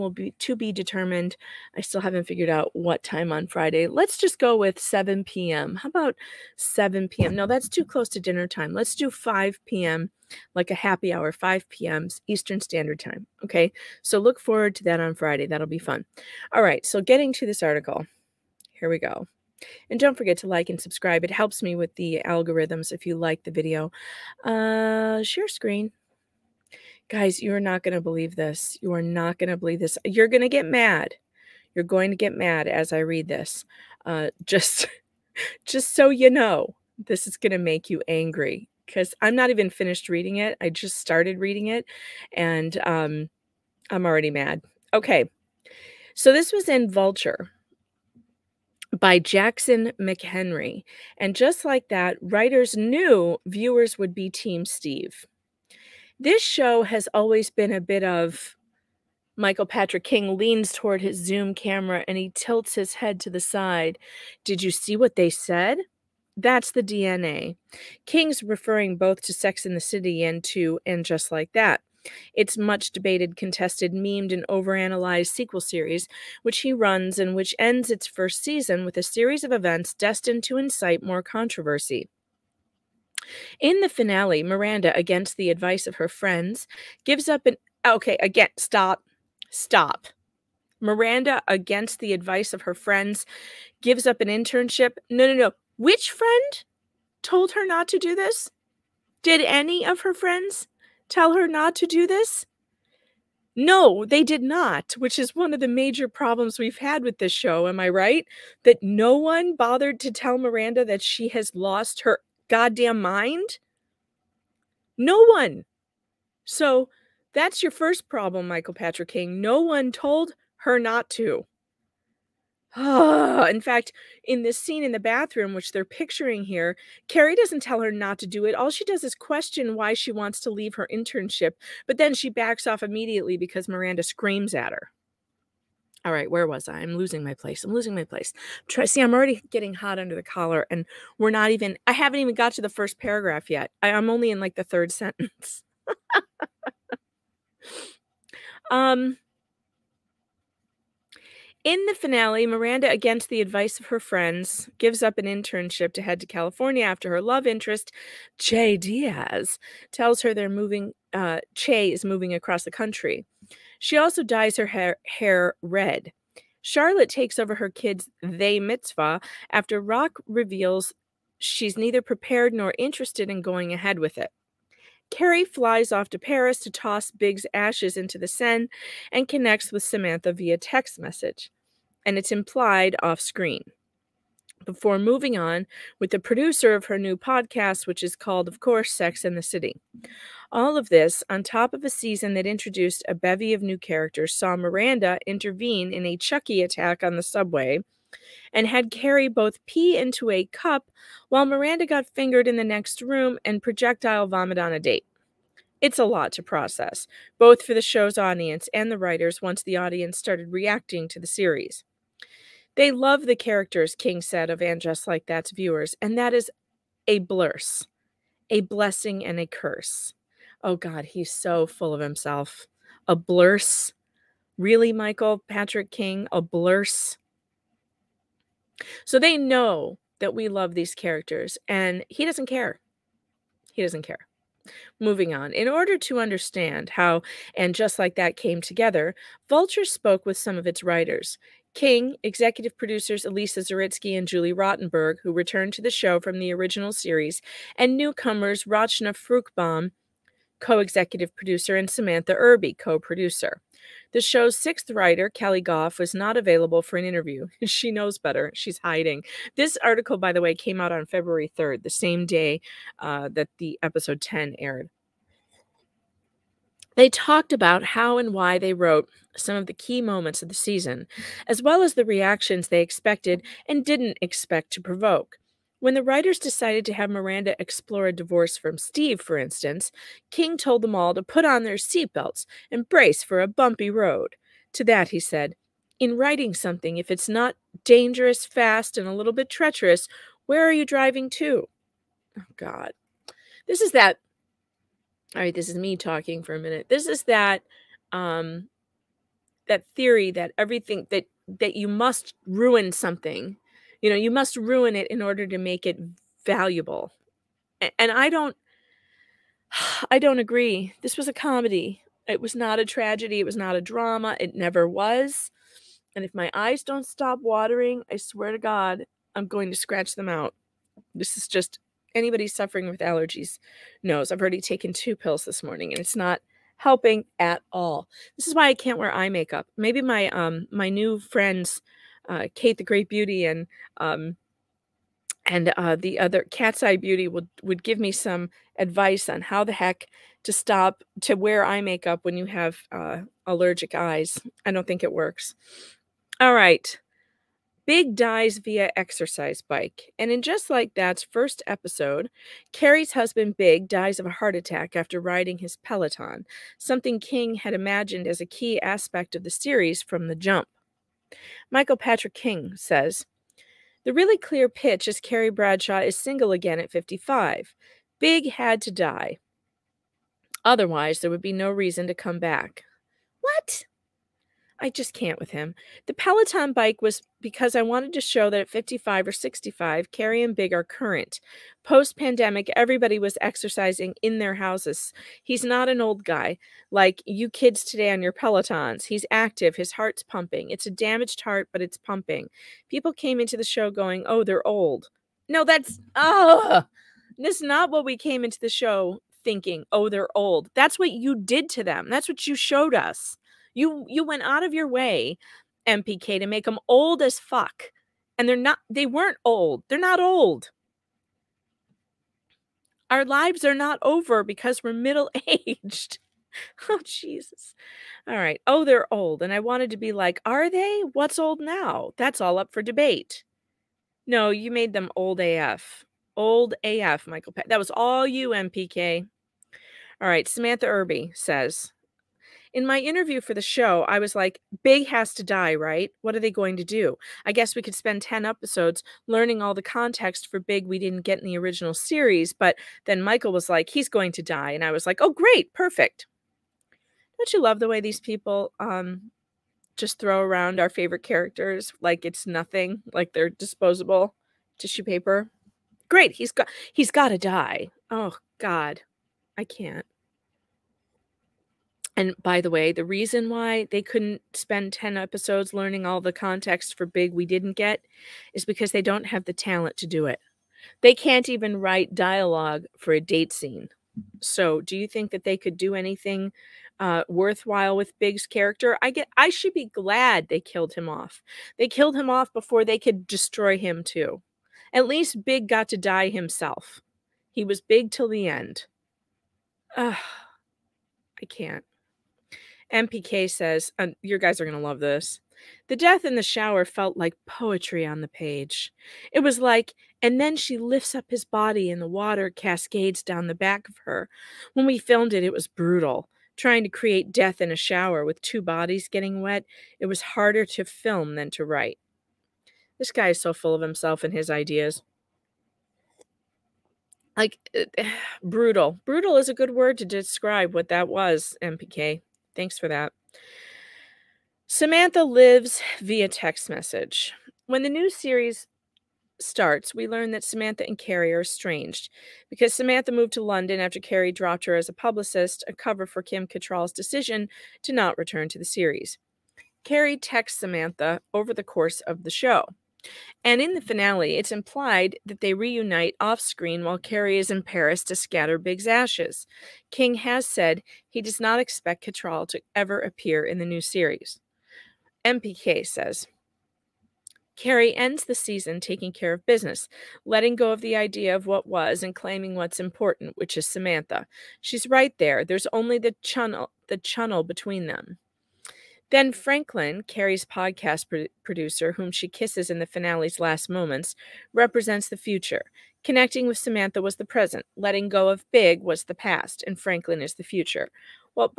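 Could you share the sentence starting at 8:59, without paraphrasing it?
Carrie texts Samantha over the course of the show.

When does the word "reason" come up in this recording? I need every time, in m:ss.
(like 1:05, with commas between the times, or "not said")
6:11, 7:43.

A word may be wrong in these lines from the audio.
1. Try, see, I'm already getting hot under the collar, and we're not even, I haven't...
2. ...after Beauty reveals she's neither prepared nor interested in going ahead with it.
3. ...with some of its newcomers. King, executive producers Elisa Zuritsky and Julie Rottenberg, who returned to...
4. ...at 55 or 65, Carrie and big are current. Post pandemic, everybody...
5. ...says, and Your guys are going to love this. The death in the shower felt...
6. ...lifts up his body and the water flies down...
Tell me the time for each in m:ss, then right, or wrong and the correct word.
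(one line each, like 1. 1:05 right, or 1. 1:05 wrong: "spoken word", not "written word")
1. 2:18 right
2. 2:49 wrong: "Rock", not "Beauty"
3. 4:00 wrong: "writers", not "newcomers"
4. 6:18 right
5. 8:13 right
6. 8:20 wrong: "cascades", not "flies".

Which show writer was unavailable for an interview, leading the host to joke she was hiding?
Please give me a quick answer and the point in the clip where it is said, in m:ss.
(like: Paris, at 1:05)
Keli Goff, at 4:15.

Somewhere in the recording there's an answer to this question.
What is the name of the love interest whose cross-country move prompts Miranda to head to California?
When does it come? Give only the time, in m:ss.
2:38.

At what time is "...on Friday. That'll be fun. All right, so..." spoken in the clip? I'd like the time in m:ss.
0:14.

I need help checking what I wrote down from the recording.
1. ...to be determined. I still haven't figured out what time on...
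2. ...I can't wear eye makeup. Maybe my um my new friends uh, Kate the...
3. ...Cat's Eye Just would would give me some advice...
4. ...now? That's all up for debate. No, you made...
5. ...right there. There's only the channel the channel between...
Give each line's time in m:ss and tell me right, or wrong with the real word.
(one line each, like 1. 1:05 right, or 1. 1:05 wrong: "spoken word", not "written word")
1. 0:00 right
2. 5:28 right
3. 5:36 wrong: "Beauty", not "Just"
4. 7:01 right
5. 9:24 right.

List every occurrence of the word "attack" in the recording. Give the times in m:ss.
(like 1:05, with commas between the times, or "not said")
3:16, 5:54.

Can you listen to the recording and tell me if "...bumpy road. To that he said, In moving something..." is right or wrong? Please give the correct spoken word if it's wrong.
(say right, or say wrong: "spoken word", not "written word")
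wrong: "writing", not "moving".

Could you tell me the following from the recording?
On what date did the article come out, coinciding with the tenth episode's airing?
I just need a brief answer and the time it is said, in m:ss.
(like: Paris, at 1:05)
February 3rd, at 4:21.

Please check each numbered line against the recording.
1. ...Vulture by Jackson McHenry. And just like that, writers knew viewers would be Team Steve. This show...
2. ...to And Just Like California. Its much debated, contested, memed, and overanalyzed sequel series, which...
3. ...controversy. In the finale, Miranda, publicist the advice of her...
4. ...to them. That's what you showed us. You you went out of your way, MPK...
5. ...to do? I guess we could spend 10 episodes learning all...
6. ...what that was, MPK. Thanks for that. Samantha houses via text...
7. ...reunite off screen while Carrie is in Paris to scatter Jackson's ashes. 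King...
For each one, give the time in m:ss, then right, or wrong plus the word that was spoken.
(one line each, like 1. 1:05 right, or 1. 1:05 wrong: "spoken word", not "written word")
1. 0:46 right
2. 1:10 wrong: "That", not "California"
3. 1:21 wrong: "against", not "publicist"
4. 6:41 right
5. 7:16 right
6. 8:40 wrong: "lives", not "houses"
7. 9:05 wrong: "Big", not "Jackson".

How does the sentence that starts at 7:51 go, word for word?
They can't even write dialogue for a date scene.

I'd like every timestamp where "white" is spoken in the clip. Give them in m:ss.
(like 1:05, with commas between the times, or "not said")
not said.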